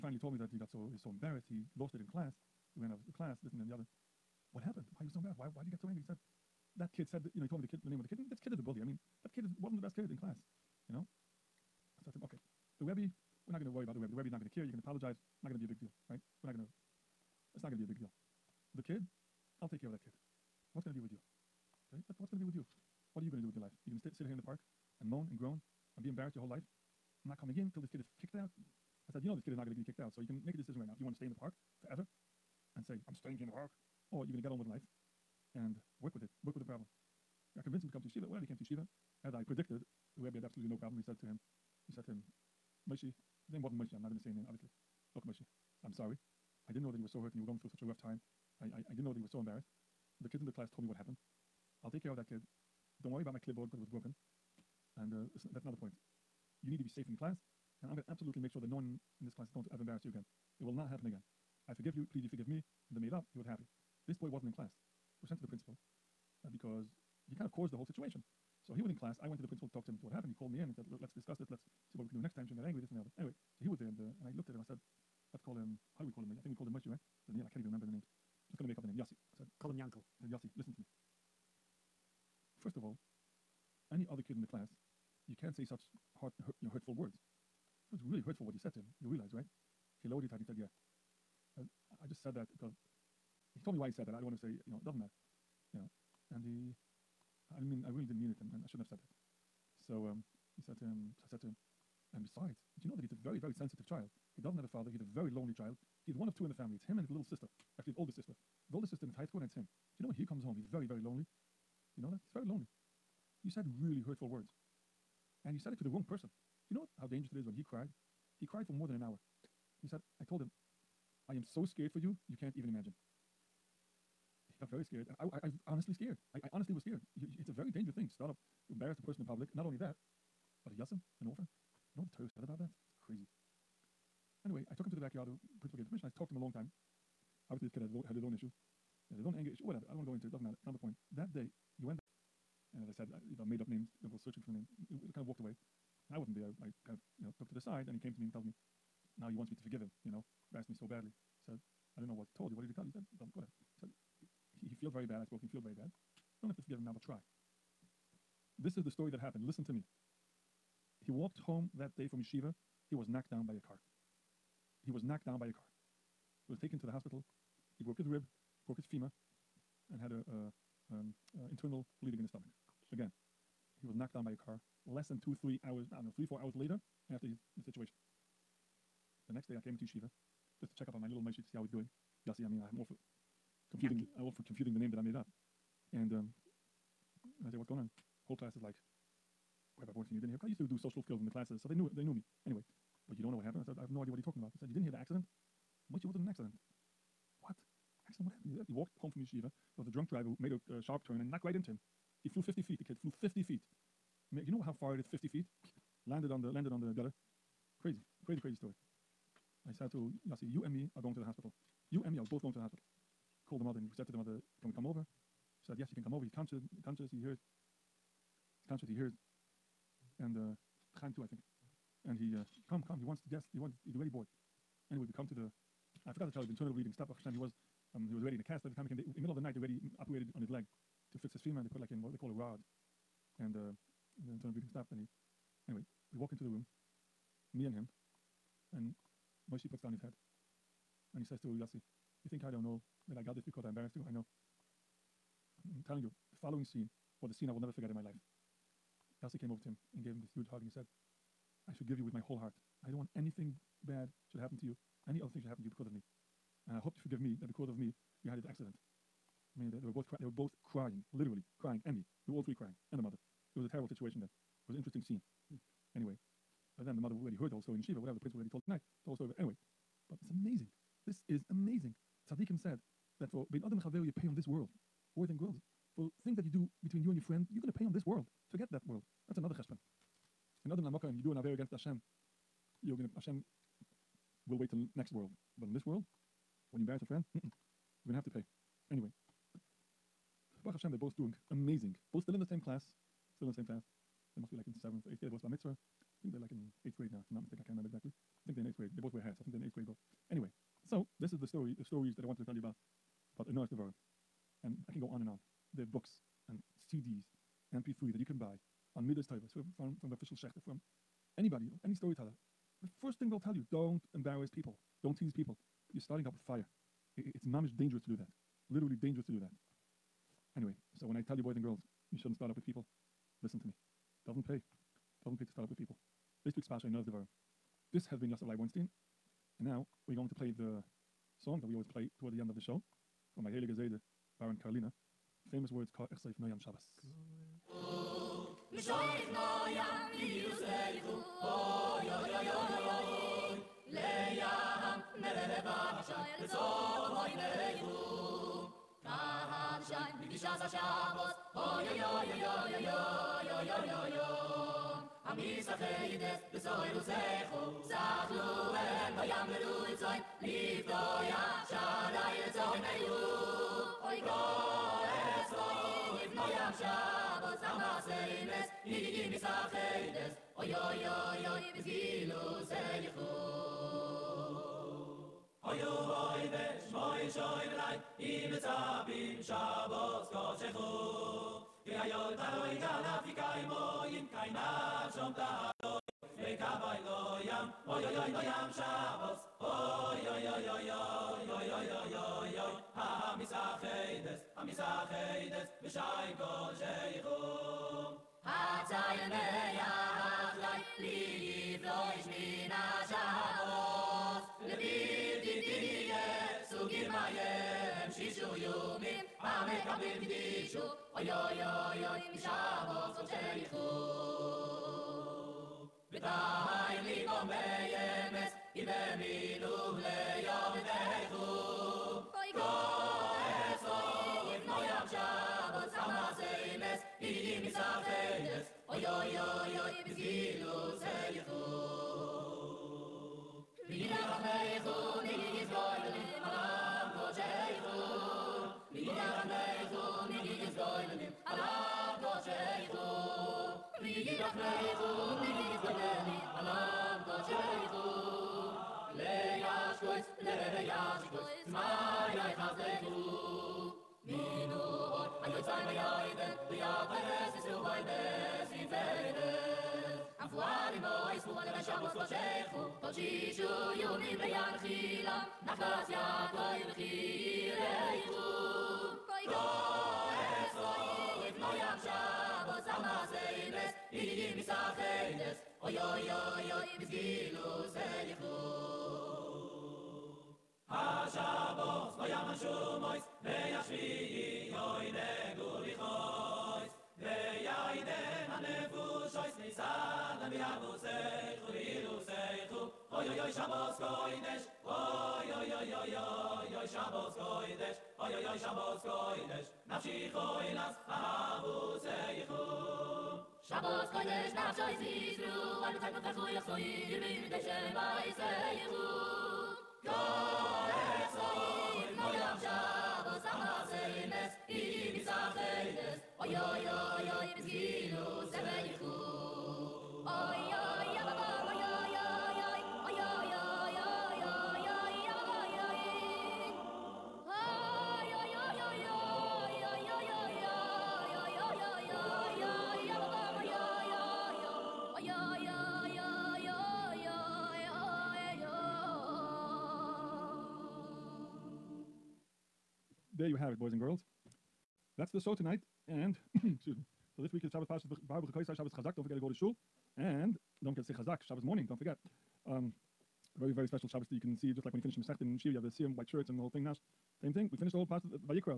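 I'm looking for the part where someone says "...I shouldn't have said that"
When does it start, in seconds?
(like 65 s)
98 s.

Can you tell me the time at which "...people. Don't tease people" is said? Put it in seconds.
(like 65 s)
314 s.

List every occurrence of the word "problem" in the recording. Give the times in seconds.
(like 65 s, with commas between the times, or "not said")
36 s, 40 s.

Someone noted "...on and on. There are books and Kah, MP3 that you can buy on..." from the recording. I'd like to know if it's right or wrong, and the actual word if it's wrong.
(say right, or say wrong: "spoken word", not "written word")
wrong: "CDs", not "Kah".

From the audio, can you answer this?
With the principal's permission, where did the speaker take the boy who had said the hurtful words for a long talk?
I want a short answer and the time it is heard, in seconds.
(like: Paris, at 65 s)
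the backyard, at 135 s.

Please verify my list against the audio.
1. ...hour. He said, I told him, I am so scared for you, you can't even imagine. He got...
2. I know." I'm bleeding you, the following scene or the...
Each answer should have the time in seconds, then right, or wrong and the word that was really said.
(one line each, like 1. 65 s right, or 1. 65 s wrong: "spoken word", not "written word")
1. 119 s right
2. 244 s wrong: "telling", not "bleeding".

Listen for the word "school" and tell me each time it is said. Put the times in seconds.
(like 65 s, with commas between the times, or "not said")
109 s.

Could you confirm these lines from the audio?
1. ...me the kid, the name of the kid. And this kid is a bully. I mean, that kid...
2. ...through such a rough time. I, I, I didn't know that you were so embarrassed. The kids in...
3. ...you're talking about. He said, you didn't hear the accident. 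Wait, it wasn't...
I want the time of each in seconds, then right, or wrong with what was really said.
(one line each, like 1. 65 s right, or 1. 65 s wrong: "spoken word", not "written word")
1. 7 s right
2. 47 s right
3. 194 s right.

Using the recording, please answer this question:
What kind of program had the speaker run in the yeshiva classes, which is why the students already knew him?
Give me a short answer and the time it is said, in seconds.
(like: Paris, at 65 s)
social skills, at 190 s.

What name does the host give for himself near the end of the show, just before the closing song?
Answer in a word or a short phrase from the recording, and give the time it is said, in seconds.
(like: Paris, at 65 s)
Yosef Leib Bornstein, at 328 s.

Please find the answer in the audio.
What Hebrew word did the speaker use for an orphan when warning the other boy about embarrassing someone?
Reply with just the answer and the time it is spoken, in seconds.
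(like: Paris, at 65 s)
yasim, at 130 s.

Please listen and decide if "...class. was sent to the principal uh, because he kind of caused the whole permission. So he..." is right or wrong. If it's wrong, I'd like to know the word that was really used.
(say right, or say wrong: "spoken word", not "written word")
wrong: "situation", not "permission".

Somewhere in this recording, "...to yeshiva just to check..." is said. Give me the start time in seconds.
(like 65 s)
179 s.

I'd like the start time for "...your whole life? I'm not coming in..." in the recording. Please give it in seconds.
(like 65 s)
26 s.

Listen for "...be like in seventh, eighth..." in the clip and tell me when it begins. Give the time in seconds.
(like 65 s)
294 s.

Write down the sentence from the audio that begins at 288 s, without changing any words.
Anyway, Baruch Hashem, they're both doing amazing.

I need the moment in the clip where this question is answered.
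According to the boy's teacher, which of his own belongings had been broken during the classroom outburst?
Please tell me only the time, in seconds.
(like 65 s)
53 s.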